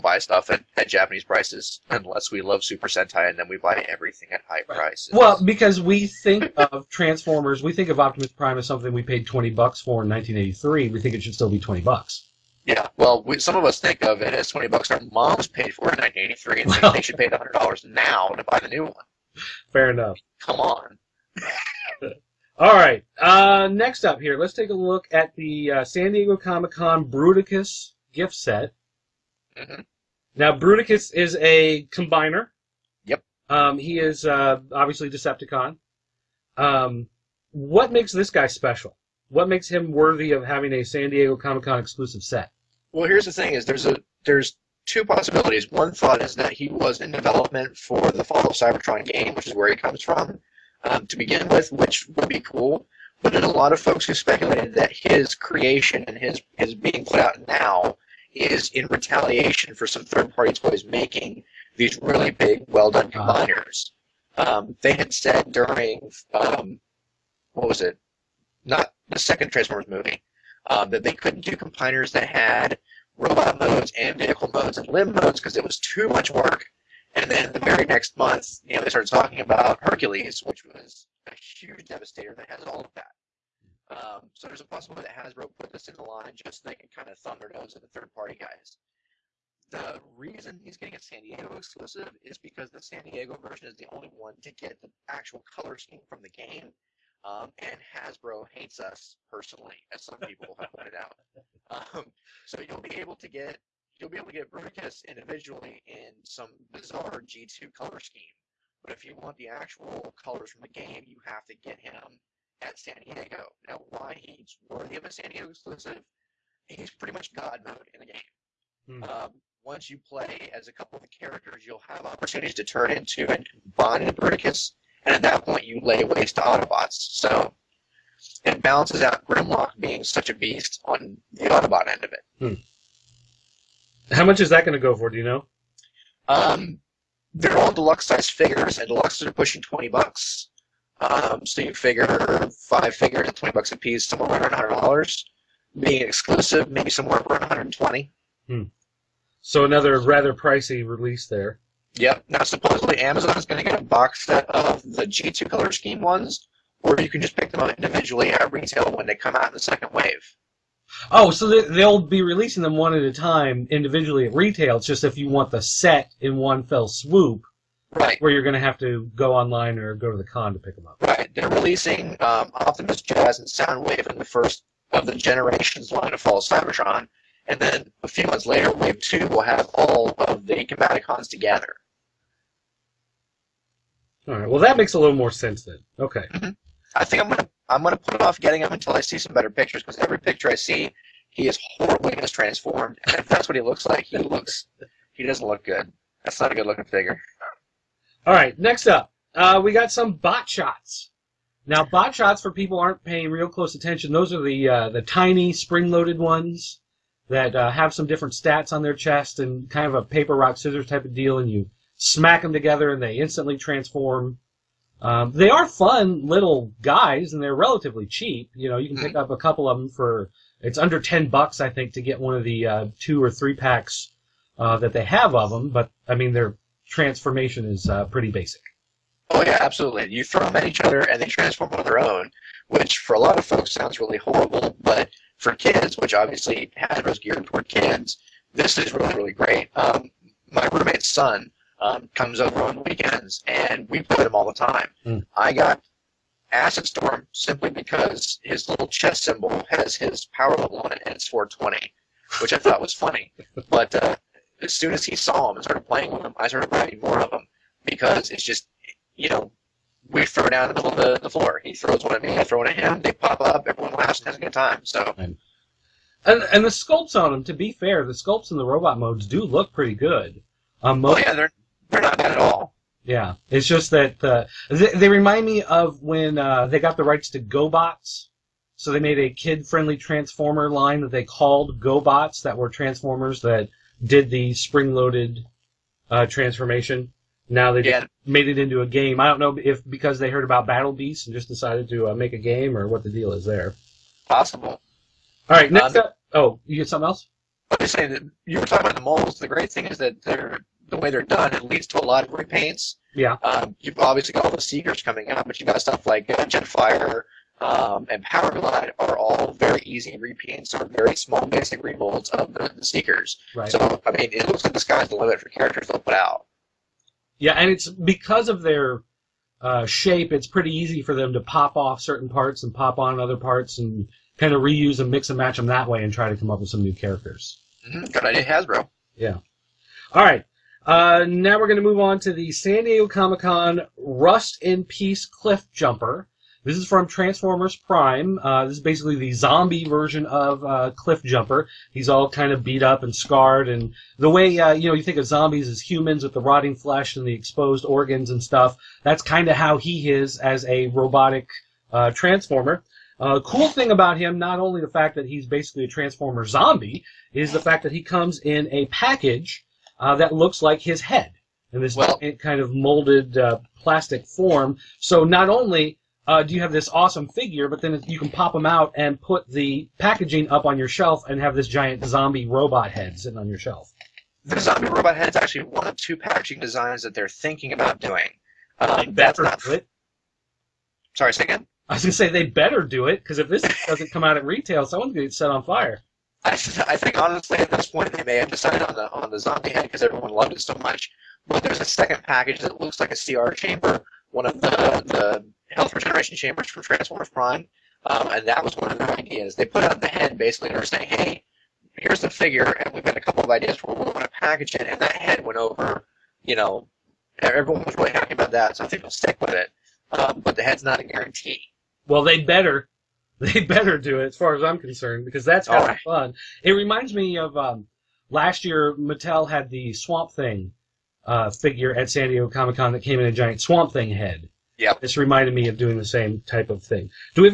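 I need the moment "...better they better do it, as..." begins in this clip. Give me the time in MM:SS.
06:52.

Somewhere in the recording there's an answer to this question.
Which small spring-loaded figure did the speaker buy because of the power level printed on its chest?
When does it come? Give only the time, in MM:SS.
04:06.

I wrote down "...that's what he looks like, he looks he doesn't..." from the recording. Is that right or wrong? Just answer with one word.
right.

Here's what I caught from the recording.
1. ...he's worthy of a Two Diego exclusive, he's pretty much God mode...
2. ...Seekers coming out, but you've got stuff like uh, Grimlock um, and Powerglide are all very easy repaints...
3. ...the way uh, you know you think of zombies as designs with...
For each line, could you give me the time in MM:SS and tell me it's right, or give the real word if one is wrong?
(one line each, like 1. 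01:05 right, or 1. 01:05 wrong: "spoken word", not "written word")
1. 01:54 wrong: "San", not "Two"
2. 05:04 wrong: "Jetfire", not "Grimlock"
3. 05:44 wrong: "humans", not "designs".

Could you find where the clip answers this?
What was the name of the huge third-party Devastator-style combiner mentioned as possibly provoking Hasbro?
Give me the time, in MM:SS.
01:19.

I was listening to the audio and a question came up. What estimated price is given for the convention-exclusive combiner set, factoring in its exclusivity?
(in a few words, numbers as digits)
$120.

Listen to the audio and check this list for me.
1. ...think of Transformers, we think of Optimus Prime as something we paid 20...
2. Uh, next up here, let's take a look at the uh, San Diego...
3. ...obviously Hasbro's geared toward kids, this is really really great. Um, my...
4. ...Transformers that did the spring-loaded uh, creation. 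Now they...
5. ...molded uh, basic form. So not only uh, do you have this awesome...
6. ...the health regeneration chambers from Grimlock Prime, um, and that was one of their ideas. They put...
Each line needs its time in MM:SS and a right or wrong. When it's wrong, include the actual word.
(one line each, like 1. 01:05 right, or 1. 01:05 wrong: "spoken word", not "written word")
1. 00:06 right
2. 00:23 right
3. 03:56 right
4. 04:42 wrong: "transformation", not "creation"
5. 06:02 wrong: "plastic", not "basic"
6. 06:35 wrong: "Transformers", not "Grimlock".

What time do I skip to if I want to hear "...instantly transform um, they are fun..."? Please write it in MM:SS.
03:33.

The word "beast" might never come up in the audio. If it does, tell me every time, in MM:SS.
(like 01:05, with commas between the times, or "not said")
02:10, 04:50.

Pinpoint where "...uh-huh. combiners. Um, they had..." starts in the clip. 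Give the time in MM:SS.
01:03.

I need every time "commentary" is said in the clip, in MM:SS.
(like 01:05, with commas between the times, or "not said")
not said.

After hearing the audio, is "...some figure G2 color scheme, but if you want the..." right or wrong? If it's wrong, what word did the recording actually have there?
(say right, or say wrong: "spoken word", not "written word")
wrong: "bizarre", not "figure".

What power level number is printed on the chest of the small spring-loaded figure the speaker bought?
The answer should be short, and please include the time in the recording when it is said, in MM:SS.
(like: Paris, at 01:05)
420, at 04:11.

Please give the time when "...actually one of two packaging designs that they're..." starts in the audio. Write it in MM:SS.
06:15.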